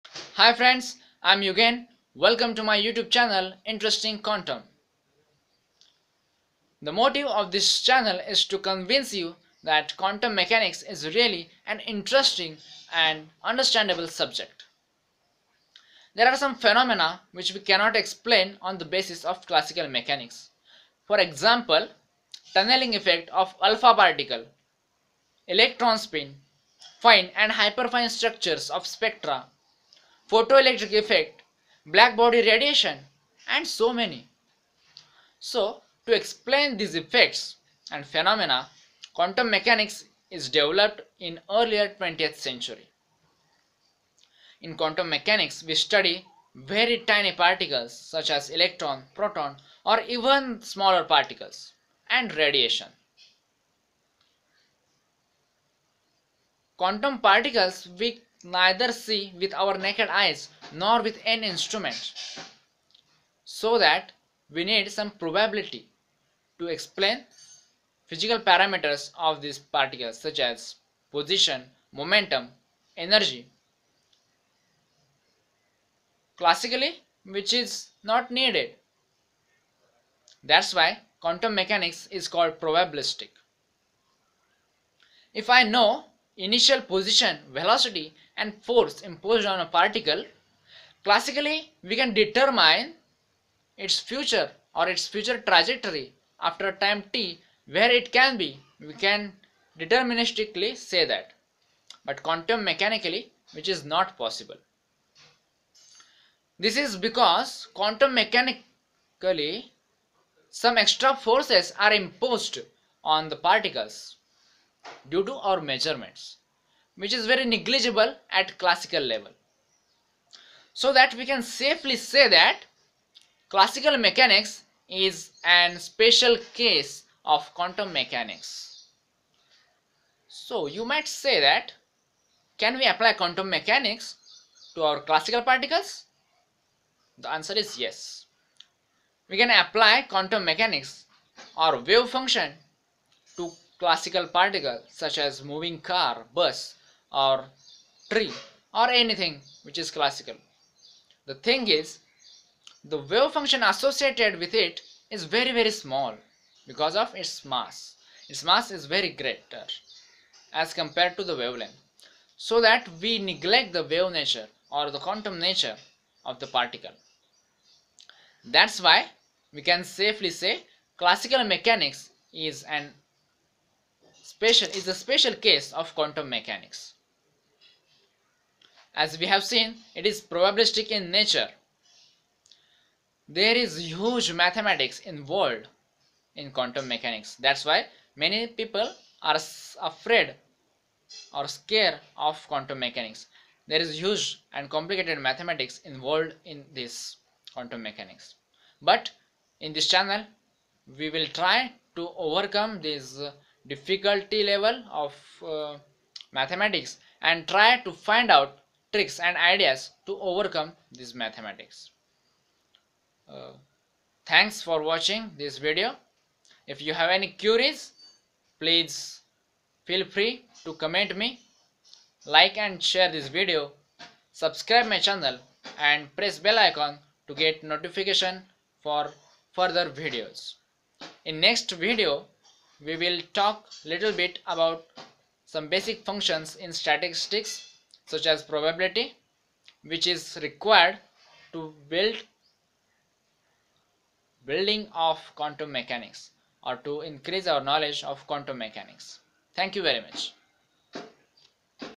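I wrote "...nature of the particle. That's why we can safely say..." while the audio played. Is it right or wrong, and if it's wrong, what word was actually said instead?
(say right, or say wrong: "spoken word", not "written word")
right.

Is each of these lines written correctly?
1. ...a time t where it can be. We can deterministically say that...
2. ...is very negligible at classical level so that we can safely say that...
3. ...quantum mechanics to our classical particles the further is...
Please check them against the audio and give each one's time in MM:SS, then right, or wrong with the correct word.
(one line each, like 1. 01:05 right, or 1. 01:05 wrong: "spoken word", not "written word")
1. 01:36 right
2. 01:57 right
3. 02:13 wrong: "answer", not "further".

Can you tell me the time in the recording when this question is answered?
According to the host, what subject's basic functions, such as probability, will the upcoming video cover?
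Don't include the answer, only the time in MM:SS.
03:56.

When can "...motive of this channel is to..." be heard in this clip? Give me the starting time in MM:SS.
00:06.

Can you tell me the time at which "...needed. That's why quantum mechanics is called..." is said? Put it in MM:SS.
01:18.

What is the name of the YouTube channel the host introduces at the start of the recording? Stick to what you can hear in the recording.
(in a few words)
Interesting Quantum.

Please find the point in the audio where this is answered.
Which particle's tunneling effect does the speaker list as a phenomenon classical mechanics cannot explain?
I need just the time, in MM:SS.
00:23.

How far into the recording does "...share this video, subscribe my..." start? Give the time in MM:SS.
03:42.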